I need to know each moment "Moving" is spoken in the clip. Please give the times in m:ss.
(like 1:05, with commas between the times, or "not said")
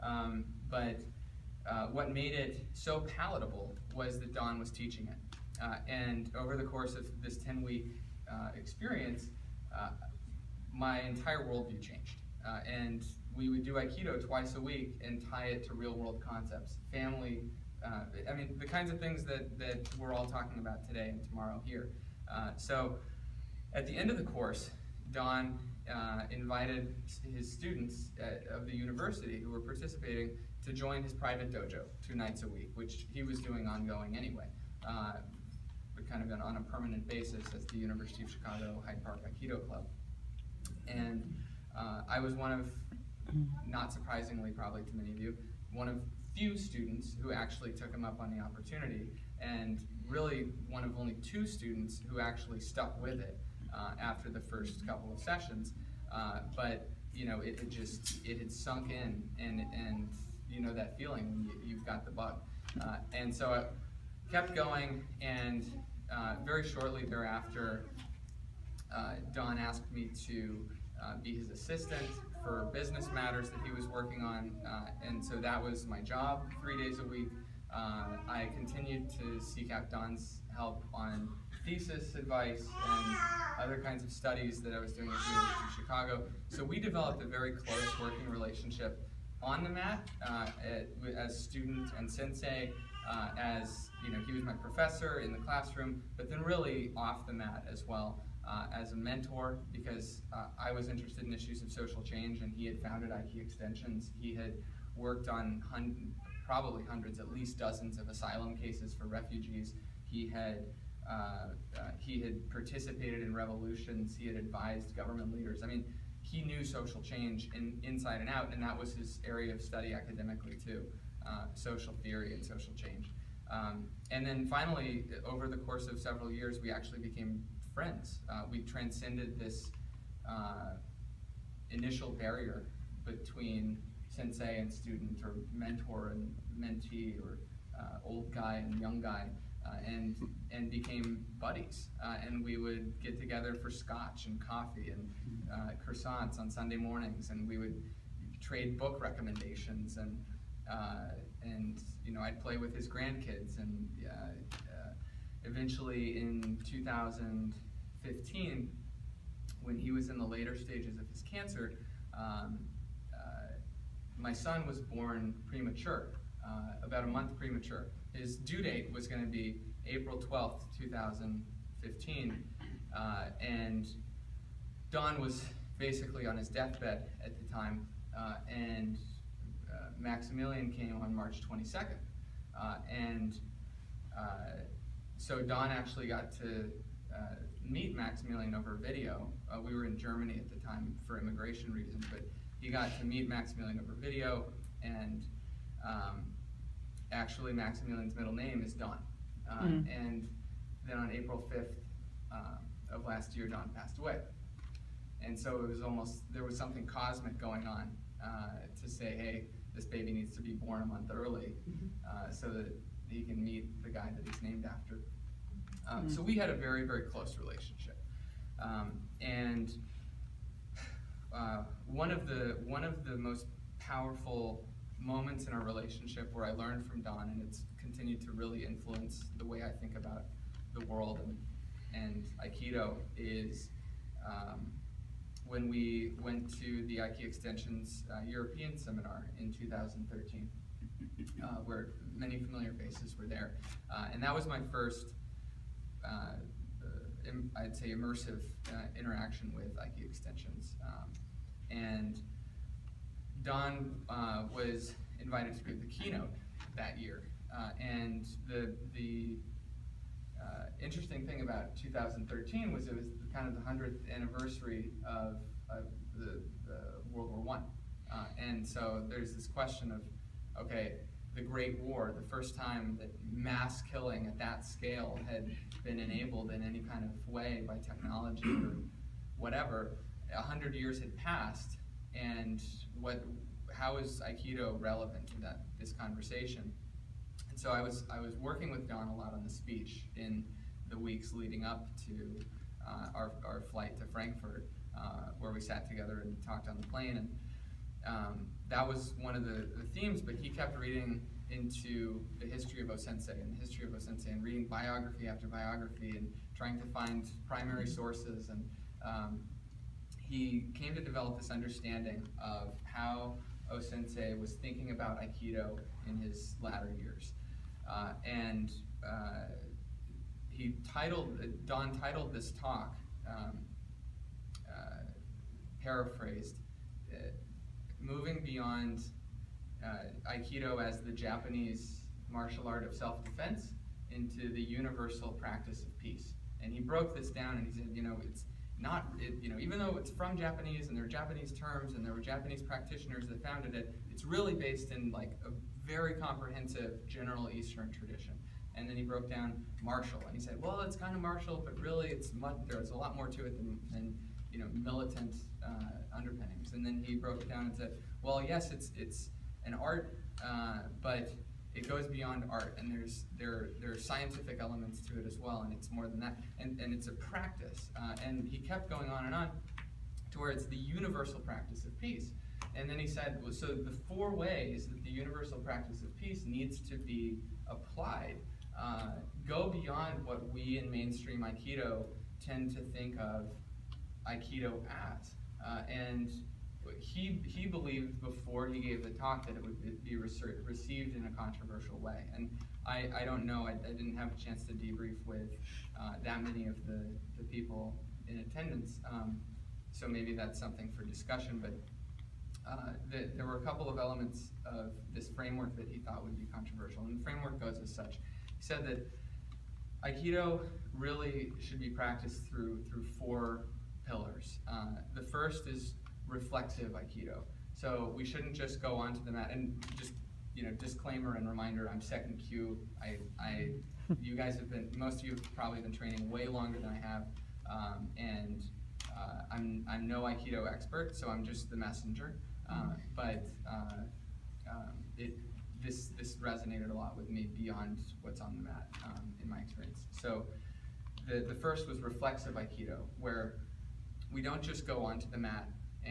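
5:28.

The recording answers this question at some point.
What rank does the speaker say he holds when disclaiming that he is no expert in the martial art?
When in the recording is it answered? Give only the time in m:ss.
7:02.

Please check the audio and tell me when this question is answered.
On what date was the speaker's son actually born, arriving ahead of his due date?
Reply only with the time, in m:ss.
3:01.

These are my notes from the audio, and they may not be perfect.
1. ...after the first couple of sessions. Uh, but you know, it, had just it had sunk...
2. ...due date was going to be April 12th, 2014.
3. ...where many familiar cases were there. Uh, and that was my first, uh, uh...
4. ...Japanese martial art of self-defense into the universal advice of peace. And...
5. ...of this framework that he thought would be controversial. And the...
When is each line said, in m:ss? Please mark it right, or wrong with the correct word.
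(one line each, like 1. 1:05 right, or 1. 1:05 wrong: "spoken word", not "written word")
1. 0:54 right
2. 2:48 wrong: "2015", not "2014"
3. 4:01 wrong: "faces", not "cases"
4. 5:31 wrong: "practice", not "advice"
5. 6:44 right.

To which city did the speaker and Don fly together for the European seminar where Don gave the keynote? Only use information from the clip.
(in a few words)
Frankfurt.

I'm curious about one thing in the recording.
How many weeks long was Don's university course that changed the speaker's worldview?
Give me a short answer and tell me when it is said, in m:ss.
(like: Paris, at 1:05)
10, at 0:07.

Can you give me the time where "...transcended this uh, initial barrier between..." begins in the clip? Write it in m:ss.
2:08.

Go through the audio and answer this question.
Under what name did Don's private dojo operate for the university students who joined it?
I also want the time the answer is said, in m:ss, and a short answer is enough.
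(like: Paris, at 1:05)
University of Chicago Hyde Park Aikido Club, at 0:37.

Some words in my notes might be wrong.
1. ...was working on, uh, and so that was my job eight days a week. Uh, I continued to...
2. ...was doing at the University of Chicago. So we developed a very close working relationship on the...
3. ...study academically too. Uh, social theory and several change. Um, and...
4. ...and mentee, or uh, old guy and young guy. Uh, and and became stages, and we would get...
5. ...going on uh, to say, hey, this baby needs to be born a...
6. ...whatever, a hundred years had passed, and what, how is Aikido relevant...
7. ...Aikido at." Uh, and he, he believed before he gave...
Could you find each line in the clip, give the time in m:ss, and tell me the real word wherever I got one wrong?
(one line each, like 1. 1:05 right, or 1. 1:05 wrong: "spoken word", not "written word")
1. 1:13 wrong: "three", not "eight"
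2. 1:24 right
3. 1:59 wrong: "social", not "several"
4. 2:16 wrong: "buddies", not "stages"
5. 3:27 right
6. 4:39 right
7. 6:24 right.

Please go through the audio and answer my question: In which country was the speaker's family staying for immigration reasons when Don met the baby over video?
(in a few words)
Germany.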